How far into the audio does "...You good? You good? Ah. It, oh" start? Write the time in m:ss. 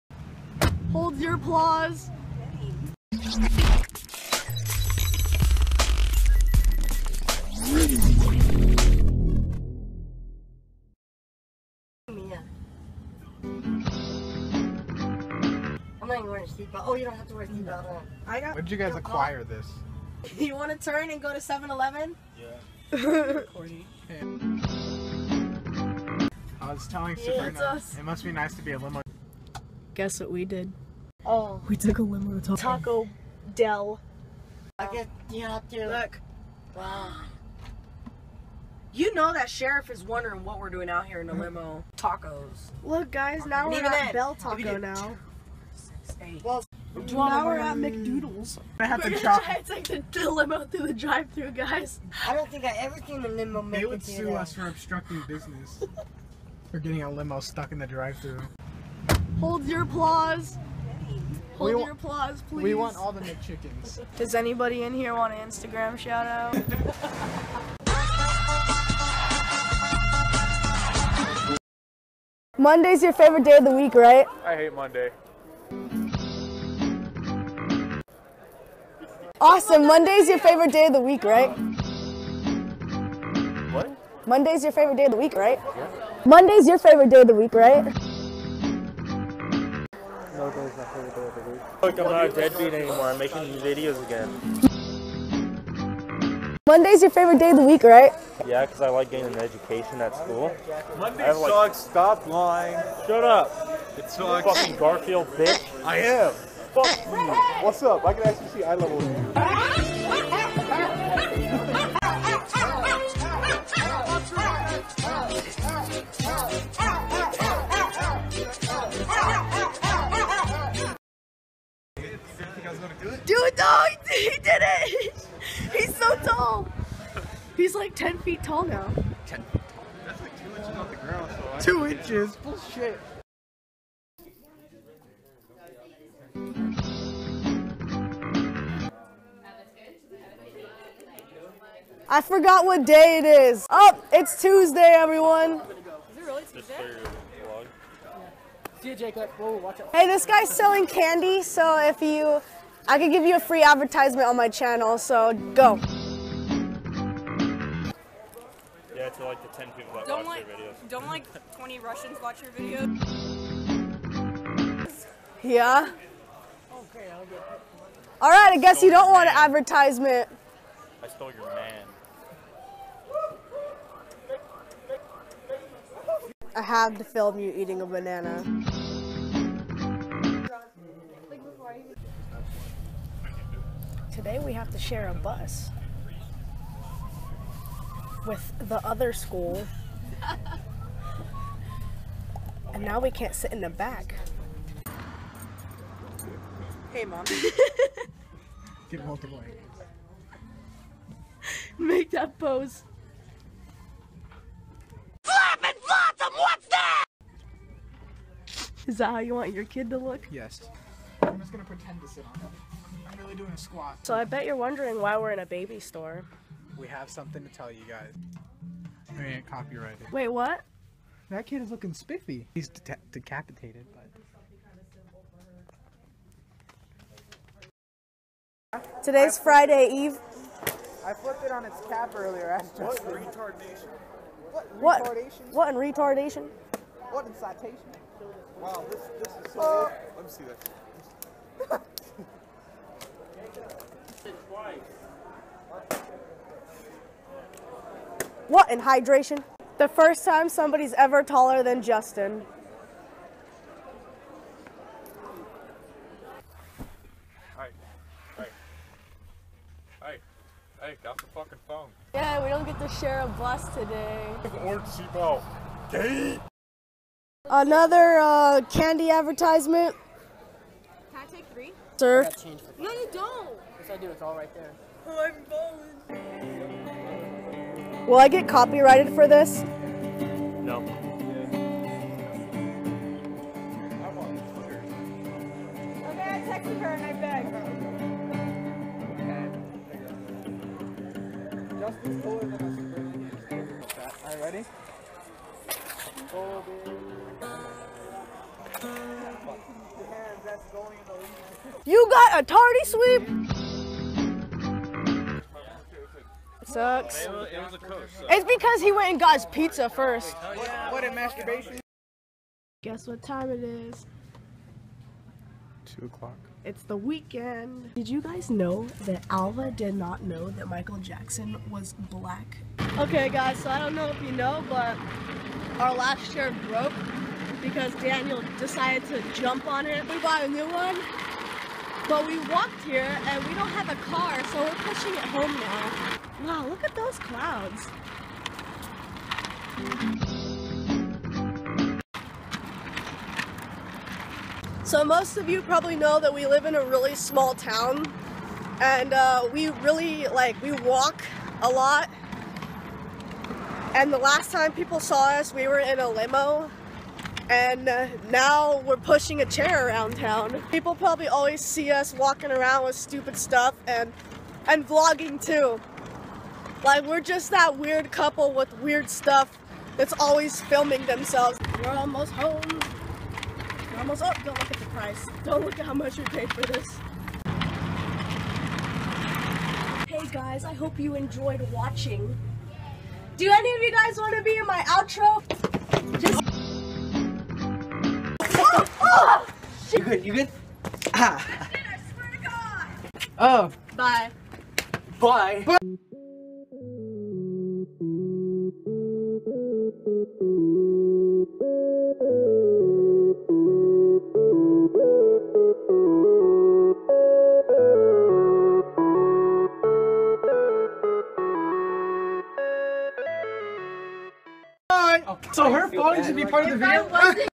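6:29.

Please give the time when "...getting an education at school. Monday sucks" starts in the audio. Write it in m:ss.
1:39.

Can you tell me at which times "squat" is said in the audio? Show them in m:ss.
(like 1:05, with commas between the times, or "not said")
3:33.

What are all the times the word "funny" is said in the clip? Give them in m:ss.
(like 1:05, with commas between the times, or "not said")
not said.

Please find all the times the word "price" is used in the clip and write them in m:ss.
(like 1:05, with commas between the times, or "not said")
6:14.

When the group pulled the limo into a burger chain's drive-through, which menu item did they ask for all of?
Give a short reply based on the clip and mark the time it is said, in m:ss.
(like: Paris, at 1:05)
McChickens, at 1:03.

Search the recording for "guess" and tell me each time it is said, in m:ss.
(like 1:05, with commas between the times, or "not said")
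0:30, 2:48, 5:12.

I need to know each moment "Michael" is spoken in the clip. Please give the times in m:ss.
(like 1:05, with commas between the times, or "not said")
5:20.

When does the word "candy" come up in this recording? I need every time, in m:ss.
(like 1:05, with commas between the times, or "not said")
2:30, 4:28.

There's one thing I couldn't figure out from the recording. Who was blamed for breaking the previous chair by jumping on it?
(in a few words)
Daniel.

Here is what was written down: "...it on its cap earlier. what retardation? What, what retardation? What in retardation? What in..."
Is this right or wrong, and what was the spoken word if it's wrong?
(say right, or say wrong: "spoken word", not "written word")
right.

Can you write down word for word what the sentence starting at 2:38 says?
Yeah, to like the 10 people that don't watch like, your videos.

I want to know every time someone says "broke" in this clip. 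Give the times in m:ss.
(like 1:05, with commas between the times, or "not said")
5:26.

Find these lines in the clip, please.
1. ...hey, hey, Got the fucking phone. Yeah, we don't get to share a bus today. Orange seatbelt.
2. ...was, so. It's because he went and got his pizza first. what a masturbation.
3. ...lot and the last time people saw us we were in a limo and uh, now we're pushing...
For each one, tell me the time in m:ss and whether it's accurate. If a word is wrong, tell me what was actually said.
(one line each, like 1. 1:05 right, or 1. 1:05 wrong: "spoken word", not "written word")
1. 4:20 right
2. 5:07 right
3. 5:51 right.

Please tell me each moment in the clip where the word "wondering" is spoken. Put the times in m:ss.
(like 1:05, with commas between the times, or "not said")
0:40, 3:34.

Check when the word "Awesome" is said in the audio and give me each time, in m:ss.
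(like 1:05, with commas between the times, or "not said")
1:19.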